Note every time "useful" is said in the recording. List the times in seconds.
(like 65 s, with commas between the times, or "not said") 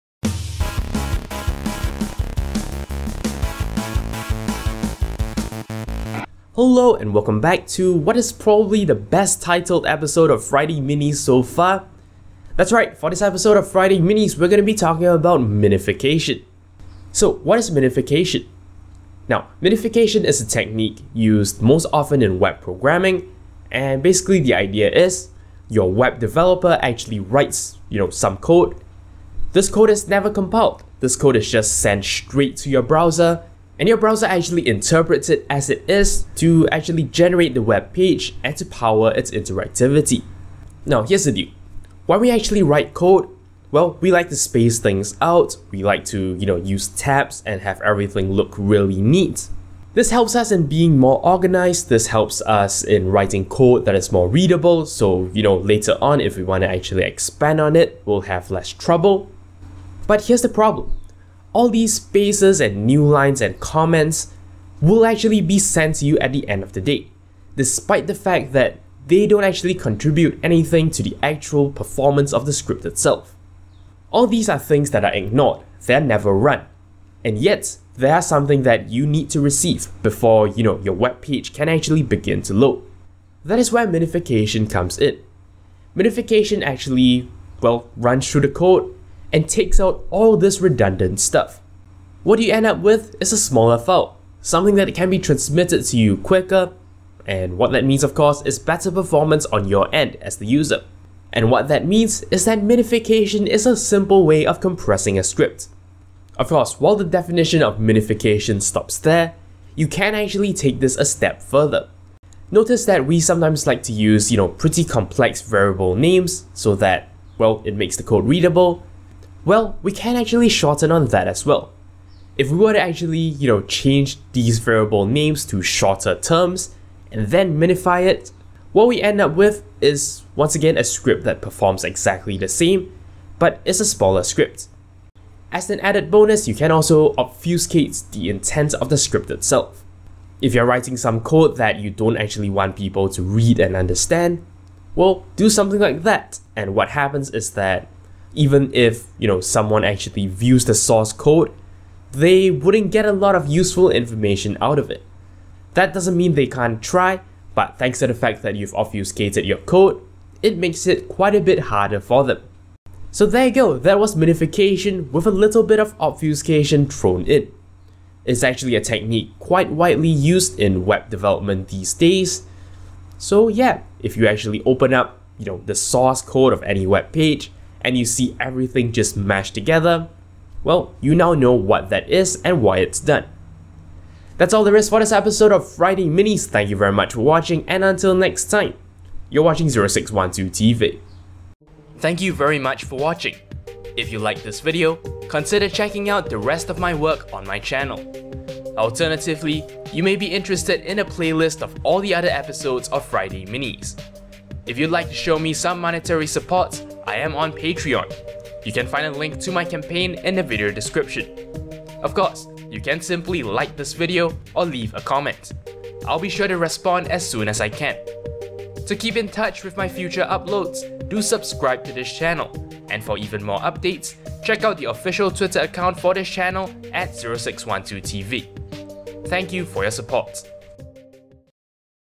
153 s.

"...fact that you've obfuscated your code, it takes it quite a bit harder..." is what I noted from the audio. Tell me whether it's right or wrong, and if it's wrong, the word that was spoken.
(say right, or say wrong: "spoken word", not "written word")
wrong: "makes", not "takes".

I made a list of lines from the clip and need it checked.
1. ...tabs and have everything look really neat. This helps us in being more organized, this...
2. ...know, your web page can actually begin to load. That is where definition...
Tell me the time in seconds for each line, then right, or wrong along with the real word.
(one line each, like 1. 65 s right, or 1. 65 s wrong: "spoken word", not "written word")
1. 46 s right
2. 80 s wrong: "minification", not "definition".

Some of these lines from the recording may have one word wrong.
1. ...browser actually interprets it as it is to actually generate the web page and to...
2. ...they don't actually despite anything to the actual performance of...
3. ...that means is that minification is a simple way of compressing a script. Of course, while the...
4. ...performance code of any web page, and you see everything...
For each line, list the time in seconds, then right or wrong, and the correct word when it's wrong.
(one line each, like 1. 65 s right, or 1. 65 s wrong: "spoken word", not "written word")
1. 33 s right
2. 69 s wrong: "contribute", not "despite"
3. 101 s right
4. 175 s wrong: "source", not "performance".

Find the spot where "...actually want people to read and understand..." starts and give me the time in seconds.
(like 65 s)
142 s.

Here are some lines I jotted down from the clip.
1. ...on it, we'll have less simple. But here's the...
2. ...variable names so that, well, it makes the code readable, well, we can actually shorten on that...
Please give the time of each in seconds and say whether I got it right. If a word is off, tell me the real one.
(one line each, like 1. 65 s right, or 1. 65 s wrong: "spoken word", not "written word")
1. 57 s wrong: "trouble", not "simple"
2. 115 s right.